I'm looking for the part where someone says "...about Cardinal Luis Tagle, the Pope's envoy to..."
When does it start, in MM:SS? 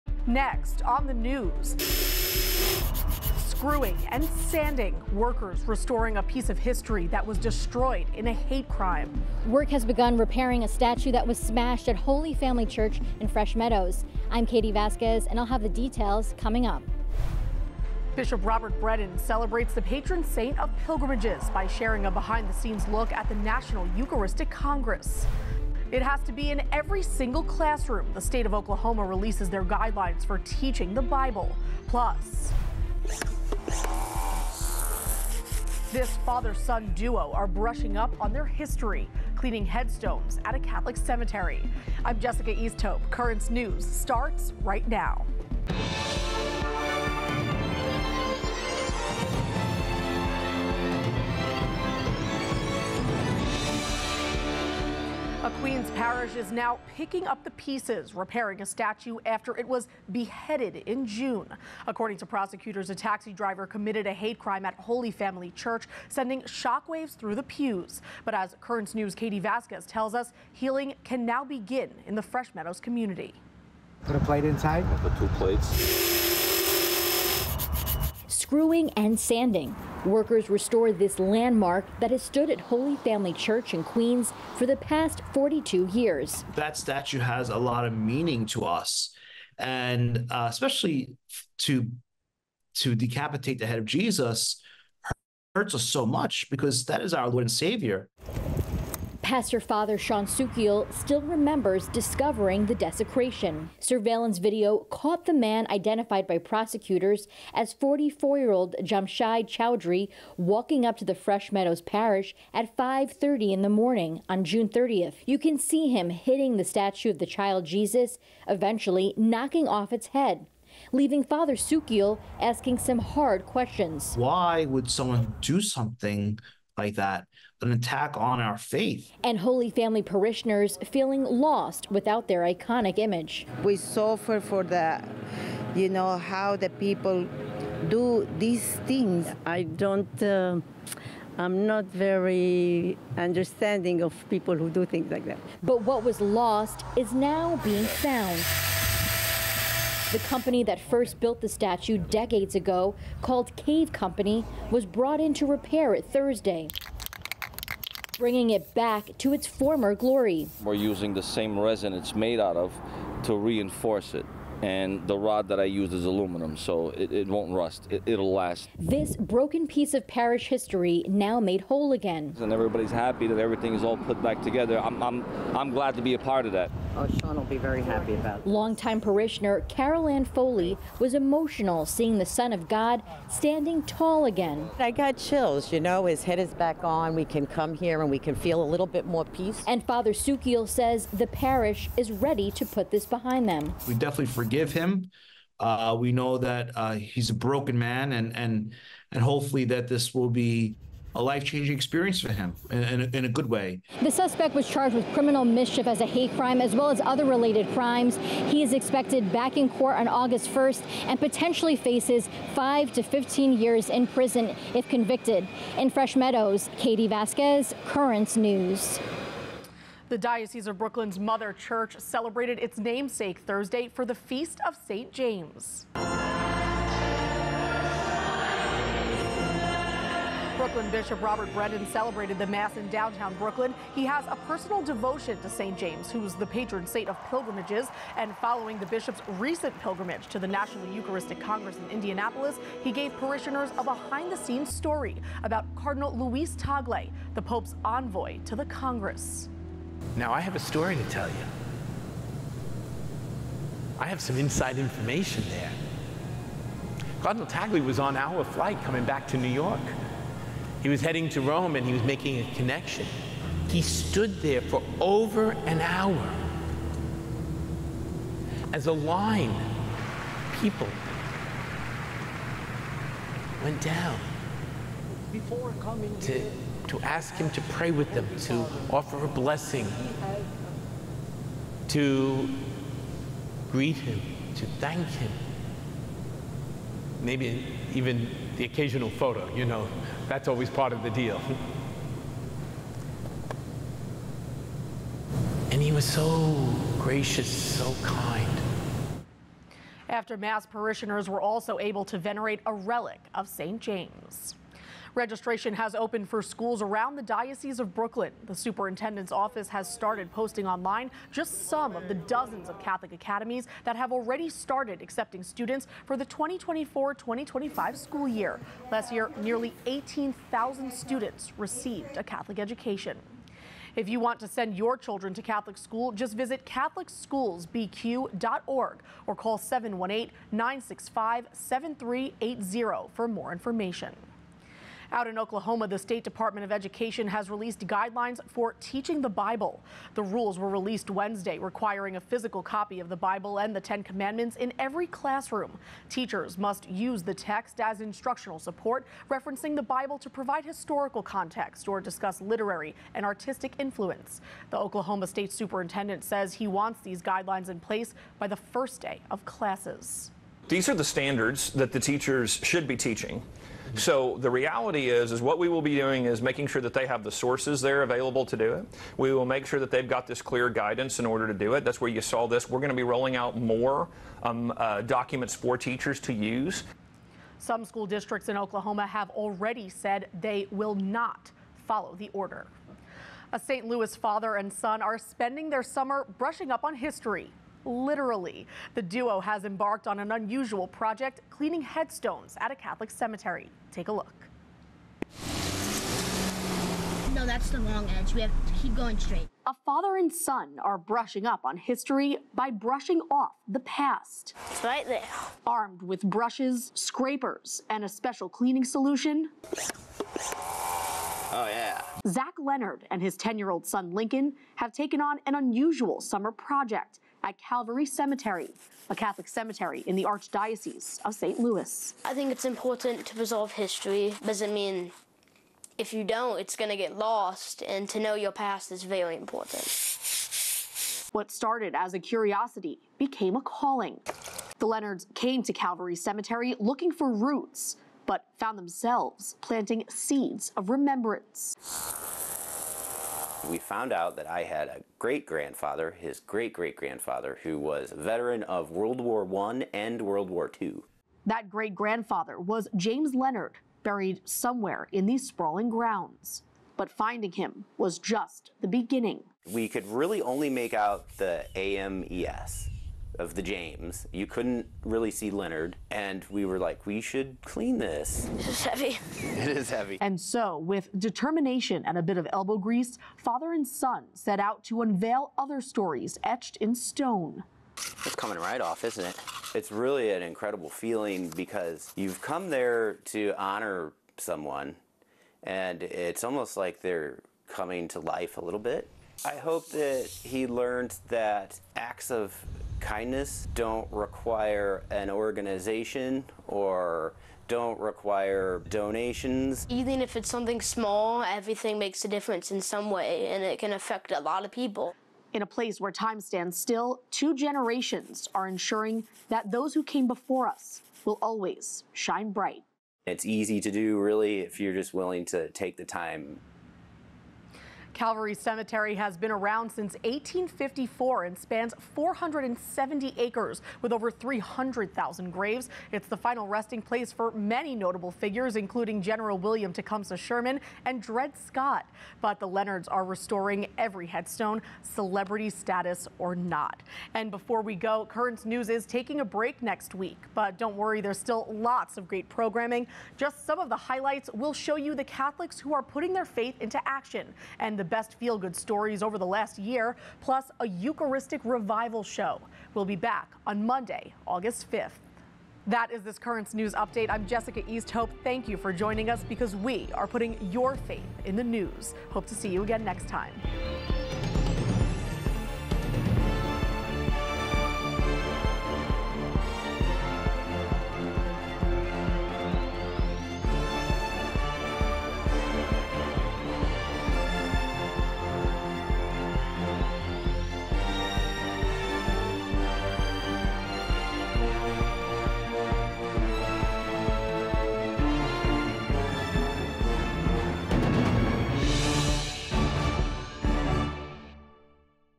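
04:05.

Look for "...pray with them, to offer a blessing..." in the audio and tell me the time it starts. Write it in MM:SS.
04:37.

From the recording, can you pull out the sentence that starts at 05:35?
Out in Oklahoma, the State Department of Education has released guidelines for teaching the Bible.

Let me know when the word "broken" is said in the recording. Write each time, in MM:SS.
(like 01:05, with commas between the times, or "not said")
02:49, 03:17.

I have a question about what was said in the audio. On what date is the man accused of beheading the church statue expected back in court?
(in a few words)
August 1.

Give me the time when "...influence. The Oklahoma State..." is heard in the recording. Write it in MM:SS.
05:53.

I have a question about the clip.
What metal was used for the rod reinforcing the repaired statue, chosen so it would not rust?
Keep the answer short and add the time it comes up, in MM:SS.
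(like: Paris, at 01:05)
Aluminum, at 02:46.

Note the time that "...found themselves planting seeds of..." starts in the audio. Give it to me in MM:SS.
07:18.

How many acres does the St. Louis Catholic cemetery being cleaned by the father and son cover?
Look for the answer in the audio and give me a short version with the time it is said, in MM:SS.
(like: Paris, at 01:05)
470, at 08:42.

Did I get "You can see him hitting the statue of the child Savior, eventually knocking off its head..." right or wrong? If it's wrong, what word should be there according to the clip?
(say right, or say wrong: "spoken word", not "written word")
wrong: "Jesus", not "Savior".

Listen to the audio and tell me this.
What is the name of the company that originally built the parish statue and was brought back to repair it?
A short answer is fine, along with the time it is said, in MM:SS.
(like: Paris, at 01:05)
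Cave Company, at 02:33.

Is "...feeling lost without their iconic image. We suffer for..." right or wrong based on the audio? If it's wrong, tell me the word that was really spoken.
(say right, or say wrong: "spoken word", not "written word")
right.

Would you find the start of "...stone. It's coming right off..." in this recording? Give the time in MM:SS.
07:56.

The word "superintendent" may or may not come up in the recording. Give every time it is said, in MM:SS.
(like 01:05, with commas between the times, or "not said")
05:08, 05:55.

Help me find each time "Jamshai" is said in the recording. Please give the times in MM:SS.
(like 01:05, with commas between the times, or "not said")
01:48.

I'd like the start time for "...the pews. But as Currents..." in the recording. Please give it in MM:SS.
01:07.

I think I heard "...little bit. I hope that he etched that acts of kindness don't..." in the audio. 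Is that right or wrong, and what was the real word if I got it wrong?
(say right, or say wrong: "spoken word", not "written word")
wrong: "learned", not "etched".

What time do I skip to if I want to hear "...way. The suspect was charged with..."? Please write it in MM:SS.
03:23.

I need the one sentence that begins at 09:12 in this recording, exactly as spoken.
We'll be back on Monday, August 5th.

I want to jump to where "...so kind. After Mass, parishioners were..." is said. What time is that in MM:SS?
04:57.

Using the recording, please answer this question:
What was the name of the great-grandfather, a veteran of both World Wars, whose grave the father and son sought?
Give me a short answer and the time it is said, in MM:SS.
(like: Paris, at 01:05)
James Leonard, at 07:32.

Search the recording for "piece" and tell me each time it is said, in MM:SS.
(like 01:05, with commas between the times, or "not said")
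00:06, 00:57, 02:49.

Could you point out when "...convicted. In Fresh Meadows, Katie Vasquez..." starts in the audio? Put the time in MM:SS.
03:34.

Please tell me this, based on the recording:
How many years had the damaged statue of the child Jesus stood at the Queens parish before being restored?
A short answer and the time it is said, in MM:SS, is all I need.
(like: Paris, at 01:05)
42, at 01:25.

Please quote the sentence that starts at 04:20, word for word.
He was heading to Rome and he was making a connection.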